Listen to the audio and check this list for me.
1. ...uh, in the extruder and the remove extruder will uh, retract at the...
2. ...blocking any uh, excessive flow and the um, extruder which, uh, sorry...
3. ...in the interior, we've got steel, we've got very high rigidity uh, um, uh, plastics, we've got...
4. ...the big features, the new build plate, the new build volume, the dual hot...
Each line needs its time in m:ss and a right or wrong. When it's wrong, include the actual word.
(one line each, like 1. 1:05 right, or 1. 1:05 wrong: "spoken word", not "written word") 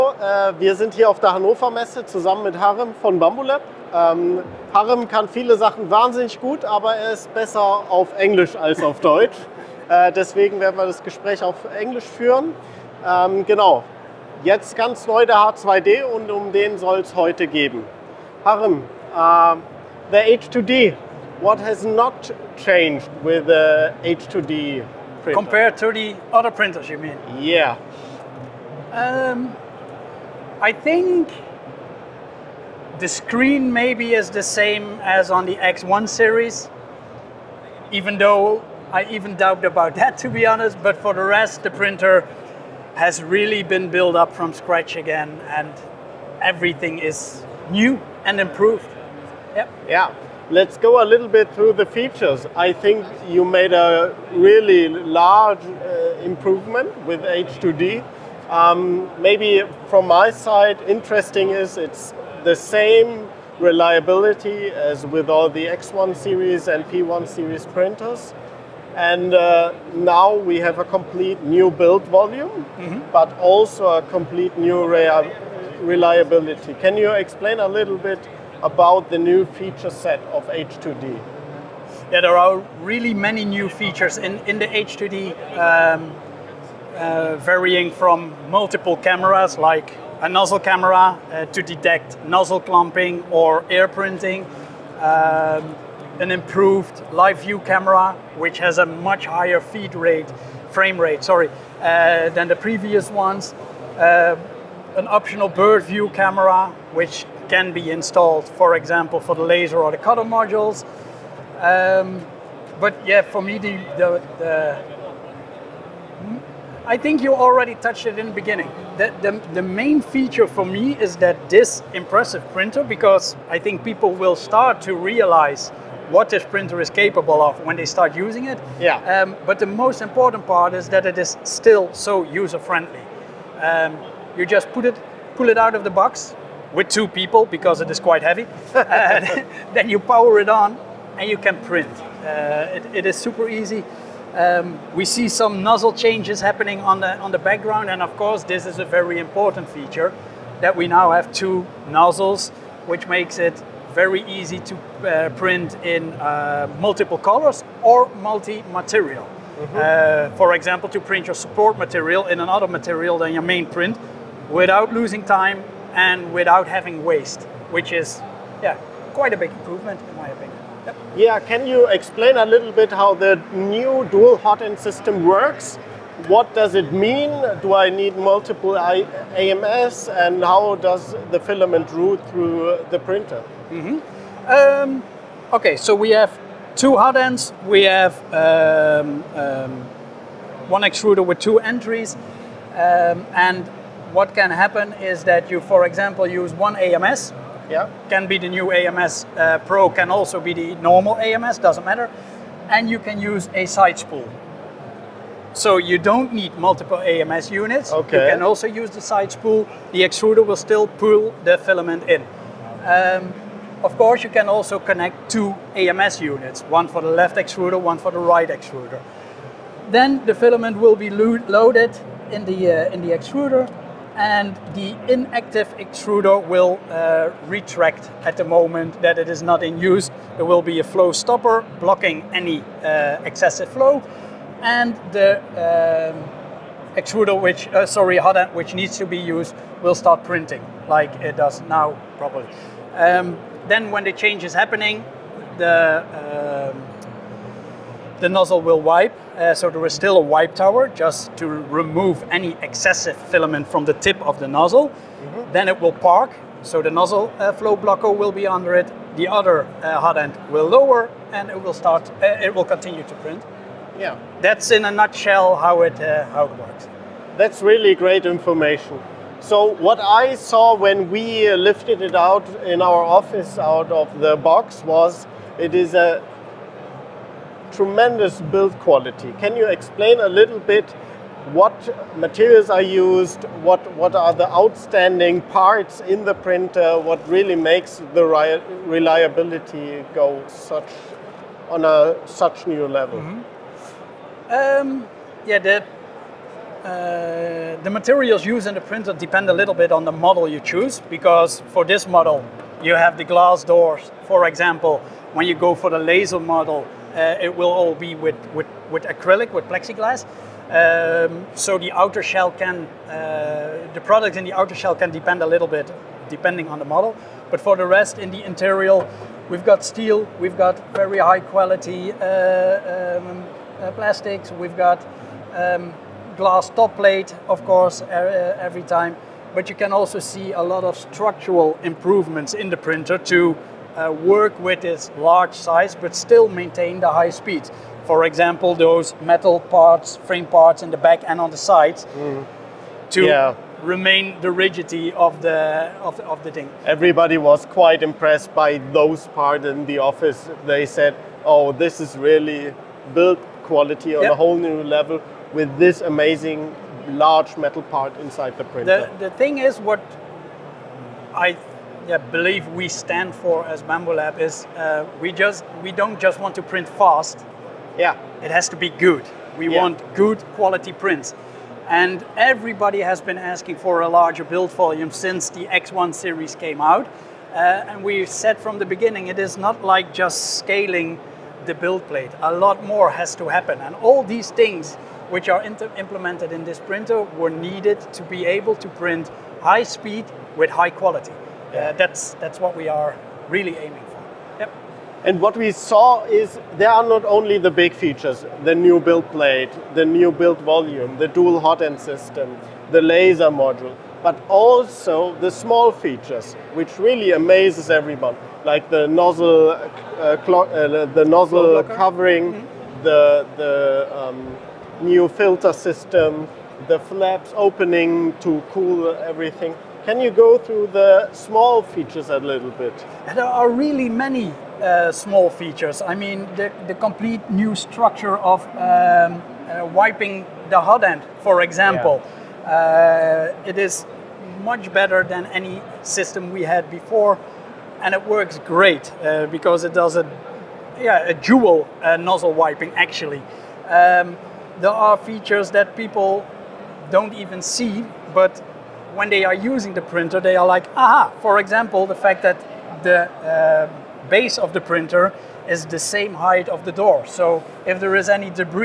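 1. 3:42 wrong: "inactive", not "remove"
2. 3:51 right
3. 5:18 wrong: "quality", not "rigidity"
4. 6:37 right.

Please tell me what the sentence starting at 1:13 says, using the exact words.
but also a complete new reliability.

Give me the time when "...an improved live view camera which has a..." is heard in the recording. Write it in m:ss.
1:36.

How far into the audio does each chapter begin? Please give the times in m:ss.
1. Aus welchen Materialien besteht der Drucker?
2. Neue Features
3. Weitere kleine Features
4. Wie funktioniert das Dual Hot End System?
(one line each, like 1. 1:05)
1. 4:39
2. 0:21
3. 6:59
4. 2:49.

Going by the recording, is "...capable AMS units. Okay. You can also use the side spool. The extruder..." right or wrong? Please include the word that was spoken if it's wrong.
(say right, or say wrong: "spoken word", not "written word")
wrong: "multiple", not "capable".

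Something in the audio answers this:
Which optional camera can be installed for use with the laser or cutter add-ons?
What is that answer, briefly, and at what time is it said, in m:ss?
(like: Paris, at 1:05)
bird view camera, at 1:45.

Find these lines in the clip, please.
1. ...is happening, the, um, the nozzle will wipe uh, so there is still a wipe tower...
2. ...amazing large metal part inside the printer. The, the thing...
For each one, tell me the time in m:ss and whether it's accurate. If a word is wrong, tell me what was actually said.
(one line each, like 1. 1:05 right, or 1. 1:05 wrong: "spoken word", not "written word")
1. 4:04 right
2. 5:56 right.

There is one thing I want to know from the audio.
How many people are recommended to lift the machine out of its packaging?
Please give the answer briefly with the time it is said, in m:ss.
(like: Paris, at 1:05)
2, at 2:16.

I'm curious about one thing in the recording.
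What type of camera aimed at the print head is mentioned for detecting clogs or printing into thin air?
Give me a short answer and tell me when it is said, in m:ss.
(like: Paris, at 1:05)
nozzle camera, at 1:30.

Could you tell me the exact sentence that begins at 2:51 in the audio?
Yeah, can you explain a little bit how the new dual hot end system works?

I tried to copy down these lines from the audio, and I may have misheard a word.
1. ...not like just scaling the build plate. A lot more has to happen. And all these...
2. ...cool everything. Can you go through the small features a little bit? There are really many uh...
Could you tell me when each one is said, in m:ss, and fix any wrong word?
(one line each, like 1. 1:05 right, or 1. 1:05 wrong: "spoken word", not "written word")
1. 6:19 right
2. 6:58 right.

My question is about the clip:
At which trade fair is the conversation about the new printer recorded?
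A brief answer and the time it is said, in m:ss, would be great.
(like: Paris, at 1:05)
Hannover Messe, at 0:01.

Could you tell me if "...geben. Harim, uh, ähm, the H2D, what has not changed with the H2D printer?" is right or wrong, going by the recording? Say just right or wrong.
right.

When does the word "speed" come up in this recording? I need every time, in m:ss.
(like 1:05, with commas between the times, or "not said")
5:37, 6:29.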